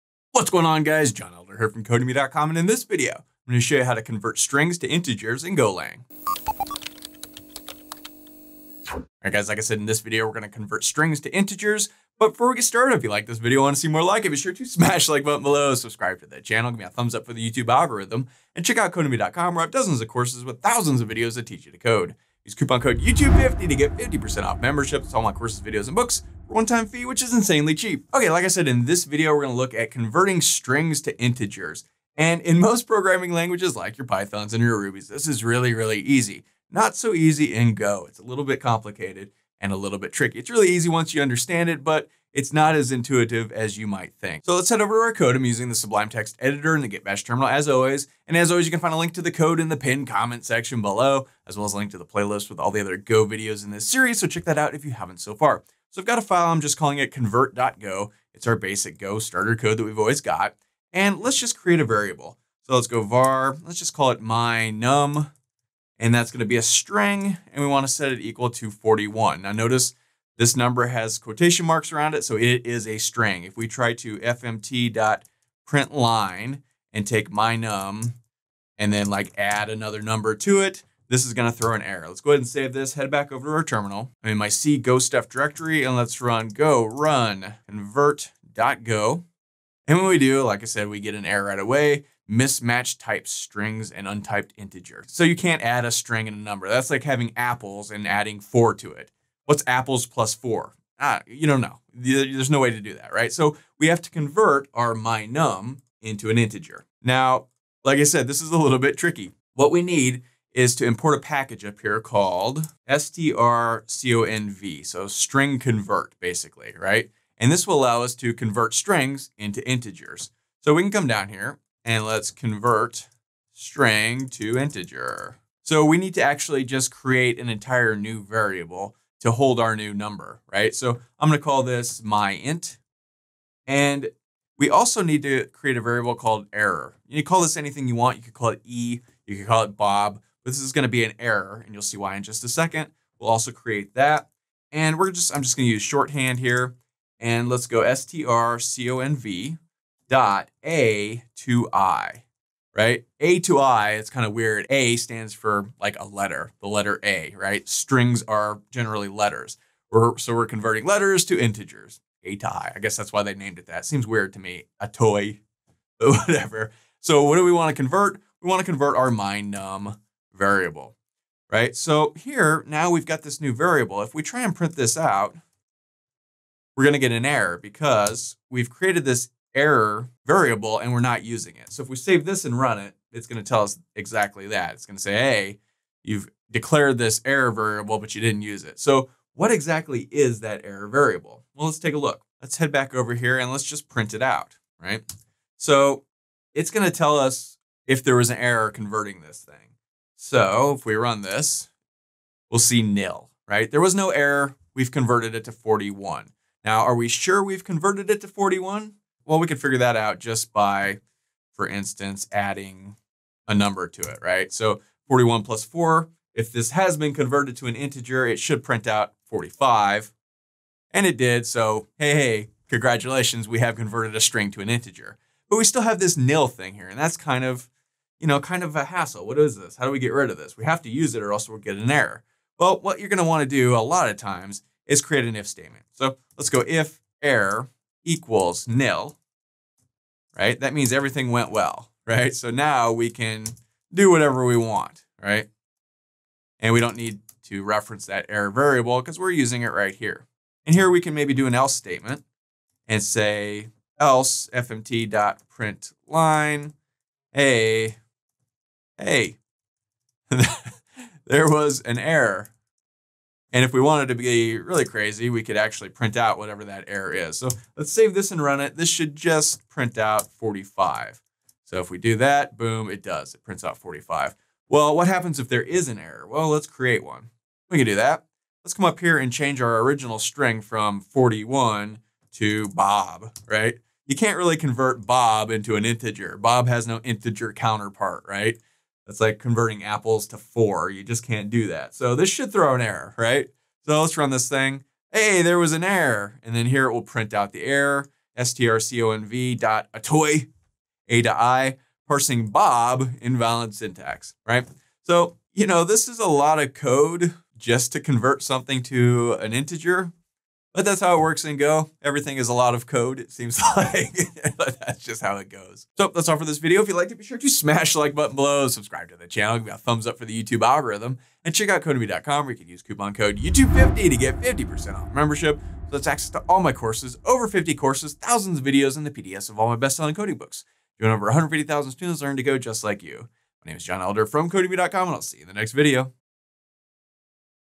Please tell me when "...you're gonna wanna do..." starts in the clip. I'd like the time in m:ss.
3:52.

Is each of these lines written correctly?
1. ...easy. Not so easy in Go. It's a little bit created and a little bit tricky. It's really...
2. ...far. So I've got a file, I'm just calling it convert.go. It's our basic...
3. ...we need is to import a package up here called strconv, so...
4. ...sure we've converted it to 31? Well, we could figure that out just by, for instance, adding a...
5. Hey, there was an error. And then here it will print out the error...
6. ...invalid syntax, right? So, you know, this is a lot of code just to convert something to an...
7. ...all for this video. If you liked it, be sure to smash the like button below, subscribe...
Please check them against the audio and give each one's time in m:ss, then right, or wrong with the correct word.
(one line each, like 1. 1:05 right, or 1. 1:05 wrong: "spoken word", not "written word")
1. 0:35 wrong: "complicated", not "created"
2. 0:55 right
3. 1:49 right
4. 3:27 wrong: "41", not "31"
5. 4:55 right
6. 5:03 right
7. 5:16 right.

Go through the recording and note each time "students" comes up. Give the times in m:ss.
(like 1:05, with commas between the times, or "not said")
5:31.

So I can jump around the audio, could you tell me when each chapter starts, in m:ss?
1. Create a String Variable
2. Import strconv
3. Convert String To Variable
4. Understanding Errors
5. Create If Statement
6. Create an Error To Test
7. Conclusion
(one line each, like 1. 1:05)
1. 0:55
2. 1:50
3. 2:05
4. 2:52
5. 3:52
6. 4:35
7. 5:05.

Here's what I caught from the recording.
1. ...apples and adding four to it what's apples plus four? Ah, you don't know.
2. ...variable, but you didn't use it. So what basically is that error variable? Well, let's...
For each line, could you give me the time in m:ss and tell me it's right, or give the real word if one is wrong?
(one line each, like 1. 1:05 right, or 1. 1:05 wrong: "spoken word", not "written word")
1. 1:37 right
2. 3:07 wrong: "exactly", not "basically".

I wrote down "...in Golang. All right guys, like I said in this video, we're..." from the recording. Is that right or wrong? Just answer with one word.
right.